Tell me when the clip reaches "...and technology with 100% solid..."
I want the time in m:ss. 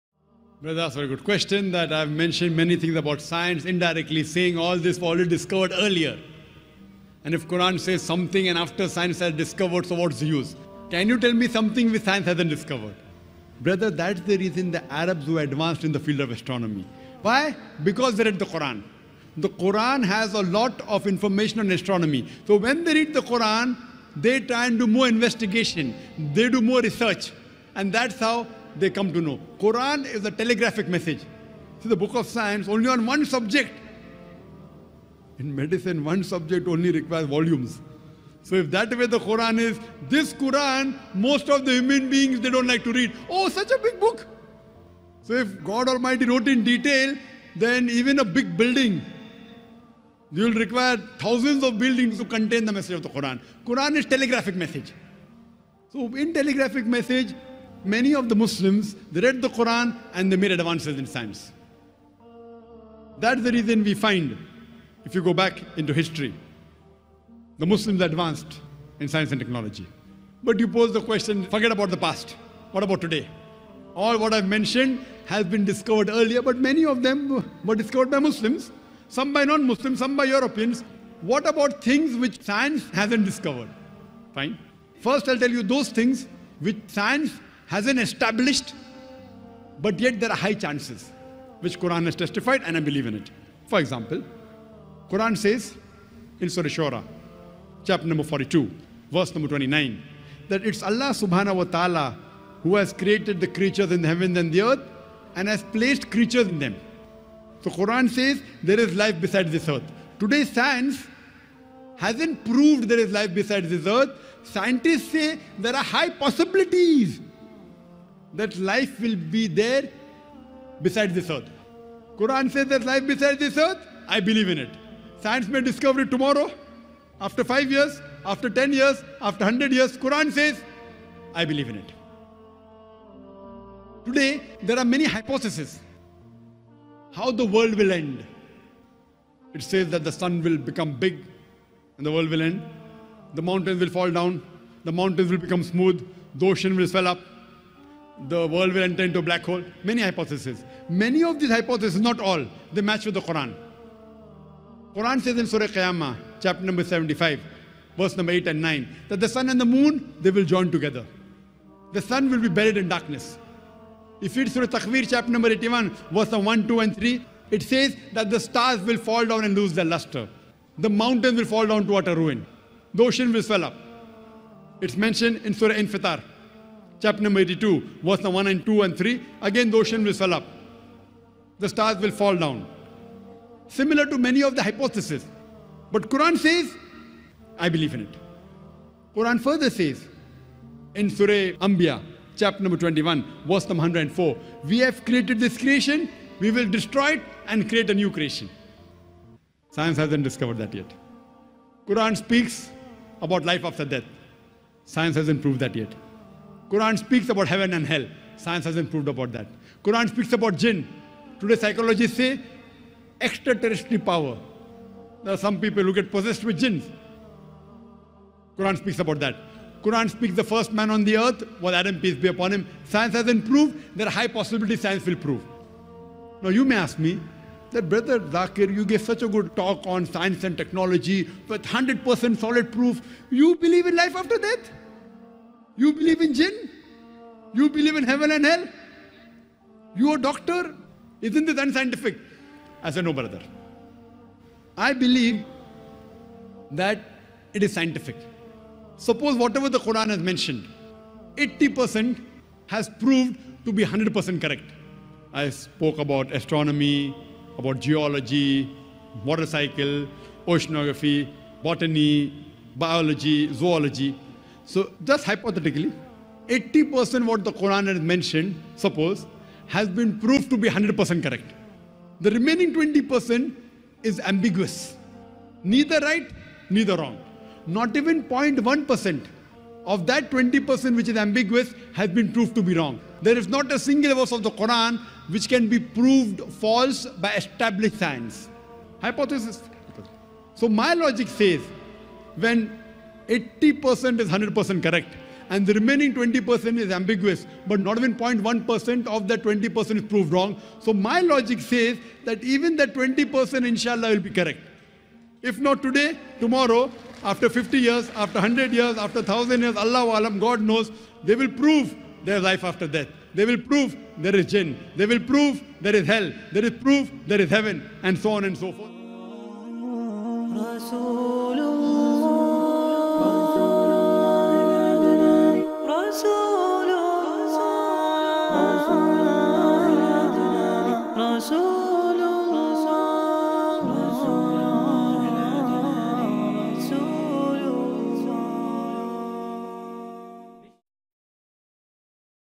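3:50.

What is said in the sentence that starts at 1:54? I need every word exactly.
Scientists say there are high possibilities that life will be there beside this earth.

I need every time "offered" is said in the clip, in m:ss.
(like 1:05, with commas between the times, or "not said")
not said.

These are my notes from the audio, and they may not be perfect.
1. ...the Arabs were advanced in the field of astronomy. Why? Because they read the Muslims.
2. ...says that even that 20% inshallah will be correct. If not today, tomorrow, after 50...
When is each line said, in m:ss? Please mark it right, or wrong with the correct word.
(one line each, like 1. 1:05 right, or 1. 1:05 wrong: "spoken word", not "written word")
1. 0:14 wrong: "Quran", not "Muslims"
2. 5:01 right.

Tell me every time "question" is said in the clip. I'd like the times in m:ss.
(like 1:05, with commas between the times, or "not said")
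0:01, 1:11.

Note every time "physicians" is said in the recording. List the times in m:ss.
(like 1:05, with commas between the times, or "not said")
not said.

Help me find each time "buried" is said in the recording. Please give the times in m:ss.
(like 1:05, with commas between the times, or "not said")
2:42.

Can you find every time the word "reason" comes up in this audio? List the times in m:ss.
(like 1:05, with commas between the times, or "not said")
0:14, 1:03.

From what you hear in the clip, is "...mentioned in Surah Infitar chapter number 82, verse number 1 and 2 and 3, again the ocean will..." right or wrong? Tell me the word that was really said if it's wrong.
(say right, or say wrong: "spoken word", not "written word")
right.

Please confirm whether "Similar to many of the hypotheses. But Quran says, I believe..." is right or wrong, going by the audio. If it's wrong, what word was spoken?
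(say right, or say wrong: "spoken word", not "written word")
right.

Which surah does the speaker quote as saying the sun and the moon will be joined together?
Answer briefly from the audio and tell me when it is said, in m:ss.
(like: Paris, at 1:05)
Surah Qiyamah, at 2:35.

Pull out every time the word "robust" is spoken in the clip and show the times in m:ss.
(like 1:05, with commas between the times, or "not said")
not said.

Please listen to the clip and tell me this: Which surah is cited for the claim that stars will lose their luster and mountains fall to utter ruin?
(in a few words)
Surah Takwir.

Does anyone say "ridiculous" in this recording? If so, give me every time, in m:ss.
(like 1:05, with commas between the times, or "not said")
not said.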